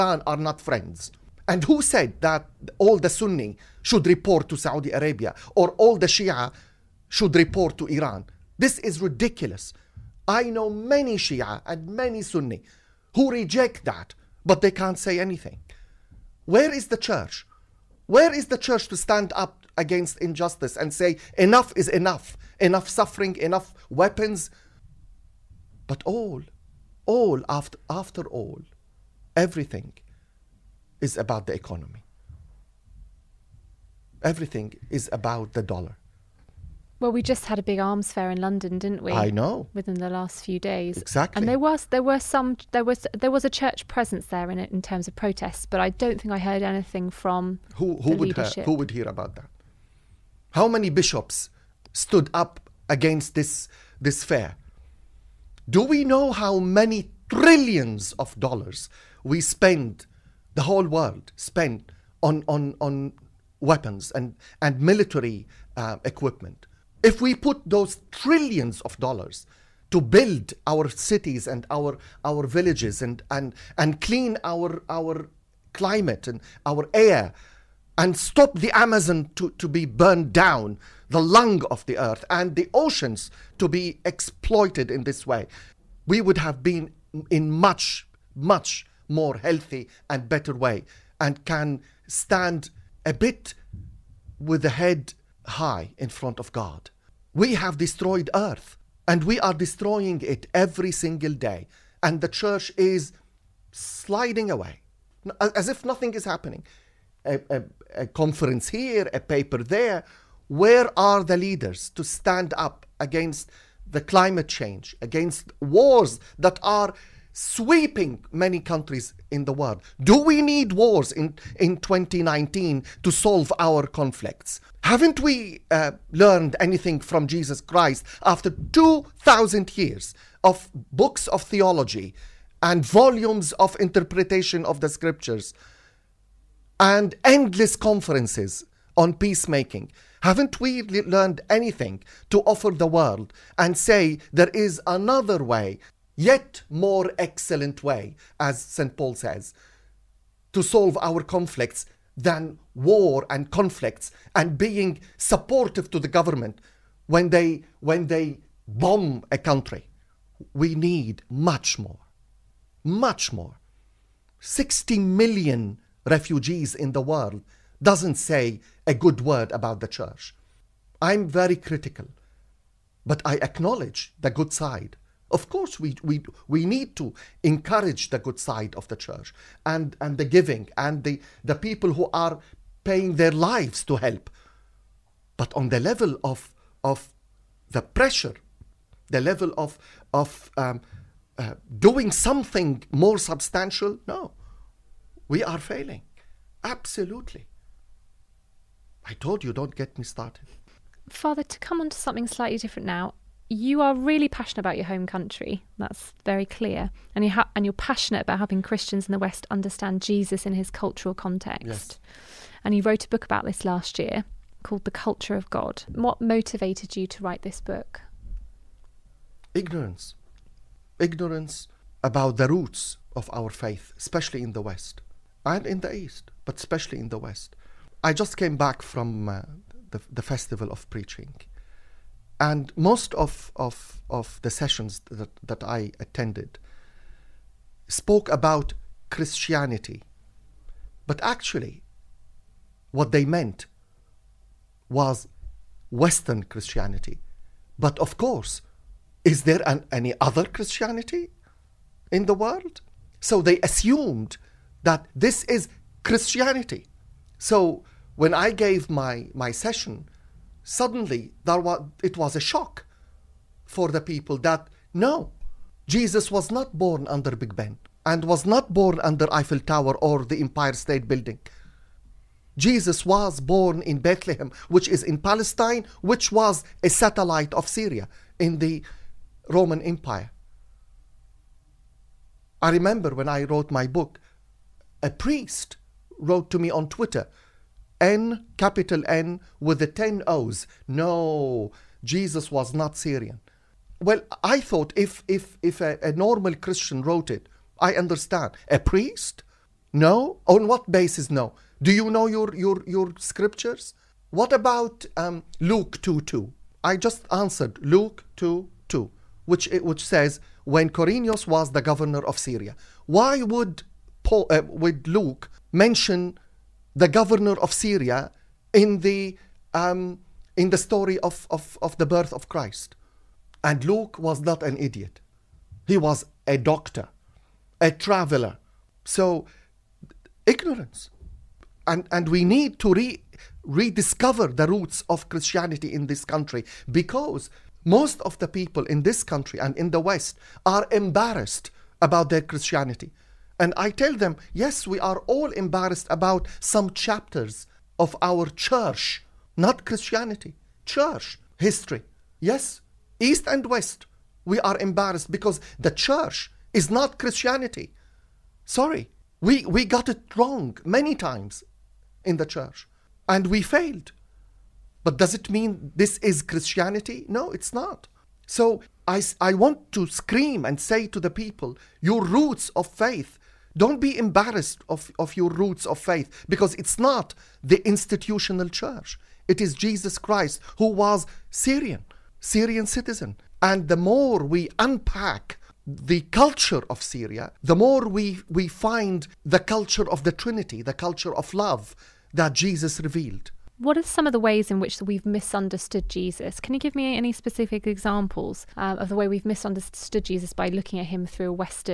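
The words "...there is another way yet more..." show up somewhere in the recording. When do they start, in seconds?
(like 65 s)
144 s.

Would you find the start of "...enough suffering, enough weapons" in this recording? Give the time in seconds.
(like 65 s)
22 s.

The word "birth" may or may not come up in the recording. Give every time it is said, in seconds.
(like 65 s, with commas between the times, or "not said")
322 s.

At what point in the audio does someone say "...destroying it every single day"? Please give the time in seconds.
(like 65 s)
99 s.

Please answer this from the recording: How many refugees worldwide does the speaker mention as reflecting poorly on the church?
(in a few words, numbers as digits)
60 million.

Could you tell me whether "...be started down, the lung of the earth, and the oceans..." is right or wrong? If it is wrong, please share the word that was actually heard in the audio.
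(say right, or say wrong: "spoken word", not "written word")
wrong: "burned", not "started".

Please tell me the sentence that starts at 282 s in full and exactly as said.
I remember when I wrote my book, a priest wrote to me on Twitter N, capital N, with the 10 O's.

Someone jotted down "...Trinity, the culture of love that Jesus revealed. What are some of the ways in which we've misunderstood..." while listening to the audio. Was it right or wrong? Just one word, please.
right.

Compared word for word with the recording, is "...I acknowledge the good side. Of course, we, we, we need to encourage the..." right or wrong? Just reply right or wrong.
right.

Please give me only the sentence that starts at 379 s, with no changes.
It is Jesus Christ who was Syrian, Syrian citizen.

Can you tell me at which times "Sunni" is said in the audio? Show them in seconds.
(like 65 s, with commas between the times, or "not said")
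3 s, 12 s.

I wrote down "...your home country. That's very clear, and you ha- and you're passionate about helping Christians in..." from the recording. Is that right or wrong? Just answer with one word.
right.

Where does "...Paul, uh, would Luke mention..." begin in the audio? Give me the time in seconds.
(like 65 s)
314 s.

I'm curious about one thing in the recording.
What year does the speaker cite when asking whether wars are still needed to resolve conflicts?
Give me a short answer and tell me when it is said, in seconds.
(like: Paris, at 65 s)
2019, at 121 s.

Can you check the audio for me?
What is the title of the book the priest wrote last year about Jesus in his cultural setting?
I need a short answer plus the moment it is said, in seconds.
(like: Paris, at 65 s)
The Culture of God, at 214 s.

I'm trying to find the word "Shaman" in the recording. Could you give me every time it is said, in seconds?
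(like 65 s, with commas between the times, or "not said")
not said.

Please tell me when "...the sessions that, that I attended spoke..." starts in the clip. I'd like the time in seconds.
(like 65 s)
234 s.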